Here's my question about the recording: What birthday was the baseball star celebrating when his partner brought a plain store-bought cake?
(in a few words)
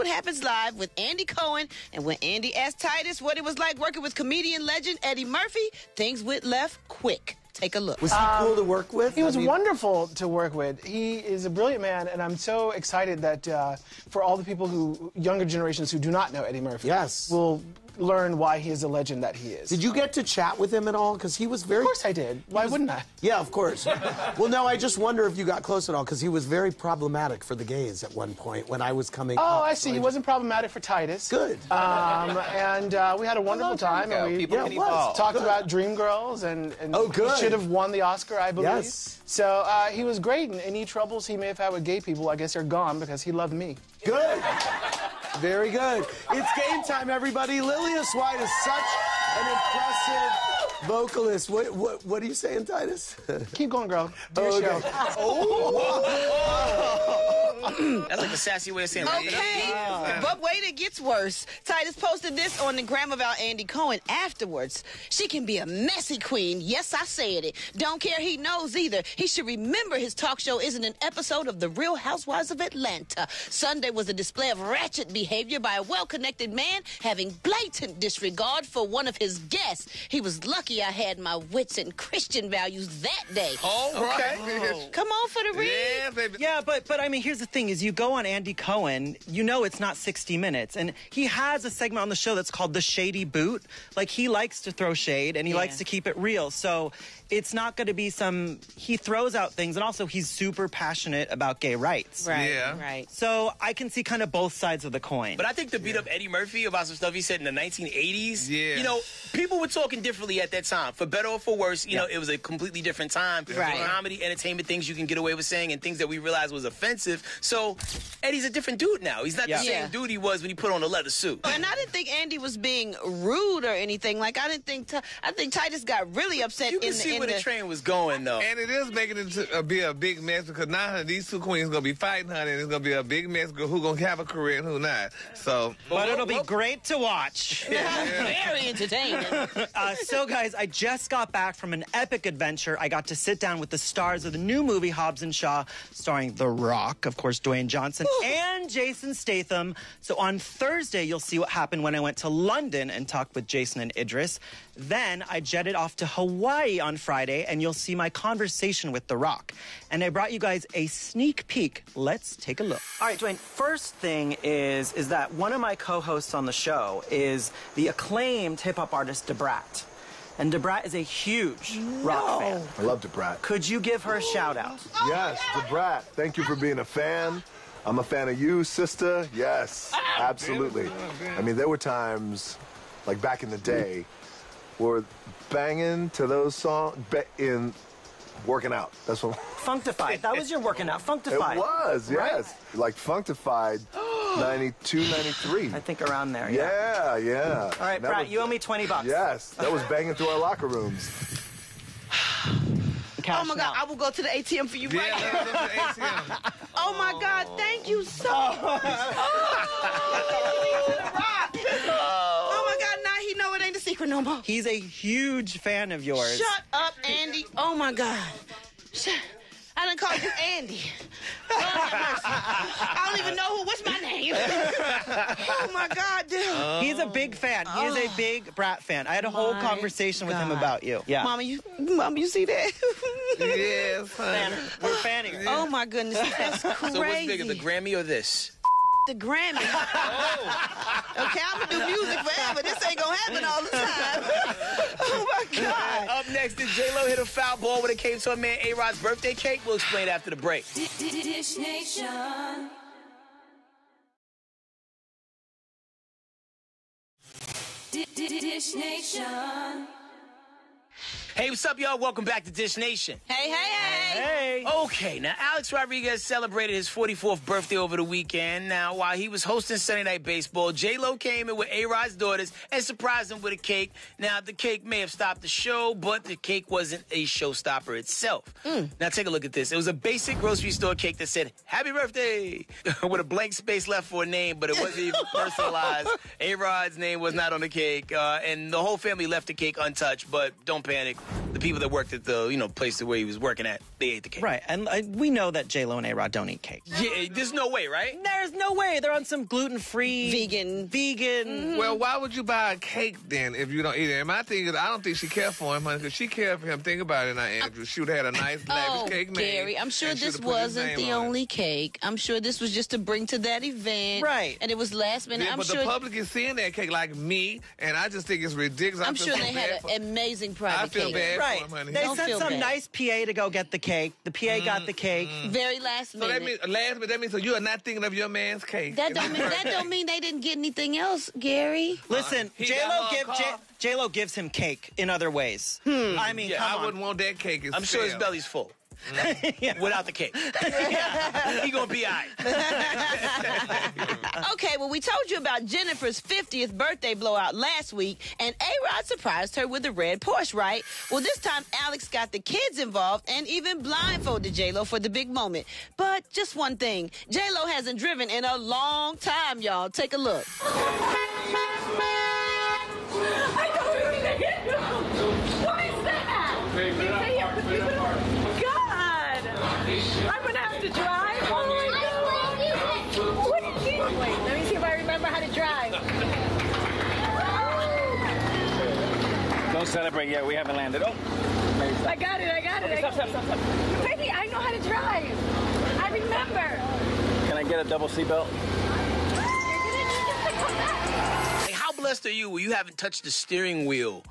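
44th.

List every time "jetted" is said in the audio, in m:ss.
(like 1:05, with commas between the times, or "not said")
2:35.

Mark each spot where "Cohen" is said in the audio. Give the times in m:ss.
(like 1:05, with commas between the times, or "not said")
0:01, 1:03, 1:28.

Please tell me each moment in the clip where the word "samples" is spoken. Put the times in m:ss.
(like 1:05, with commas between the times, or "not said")
not said.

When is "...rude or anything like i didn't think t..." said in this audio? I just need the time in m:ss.
2:03.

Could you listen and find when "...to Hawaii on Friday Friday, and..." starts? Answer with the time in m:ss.
2:35.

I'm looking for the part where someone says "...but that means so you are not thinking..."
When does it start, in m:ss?
5:27.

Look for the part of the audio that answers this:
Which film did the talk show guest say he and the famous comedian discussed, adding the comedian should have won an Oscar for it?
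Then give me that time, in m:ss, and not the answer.
0:35.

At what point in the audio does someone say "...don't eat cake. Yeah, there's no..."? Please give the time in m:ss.
4:56.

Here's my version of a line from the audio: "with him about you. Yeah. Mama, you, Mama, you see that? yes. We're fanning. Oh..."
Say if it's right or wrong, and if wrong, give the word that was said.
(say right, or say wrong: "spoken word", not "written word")
right.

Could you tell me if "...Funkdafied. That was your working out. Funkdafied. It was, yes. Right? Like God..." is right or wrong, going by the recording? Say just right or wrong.
wrong.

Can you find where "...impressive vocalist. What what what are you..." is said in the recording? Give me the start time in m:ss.
0:49.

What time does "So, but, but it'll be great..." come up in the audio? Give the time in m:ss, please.
2:15.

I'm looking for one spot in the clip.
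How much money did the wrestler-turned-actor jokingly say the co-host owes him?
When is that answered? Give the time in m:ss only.
3:18.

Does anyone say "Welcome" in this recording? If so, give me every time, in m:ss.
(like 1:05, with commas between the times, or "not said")
4:21.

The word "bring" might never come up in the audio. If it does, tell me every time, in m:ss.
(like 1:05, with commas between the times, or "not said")
5:12.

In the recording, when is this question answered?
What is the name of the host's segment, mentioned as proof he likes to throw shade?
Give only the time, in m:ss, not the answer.
1:32.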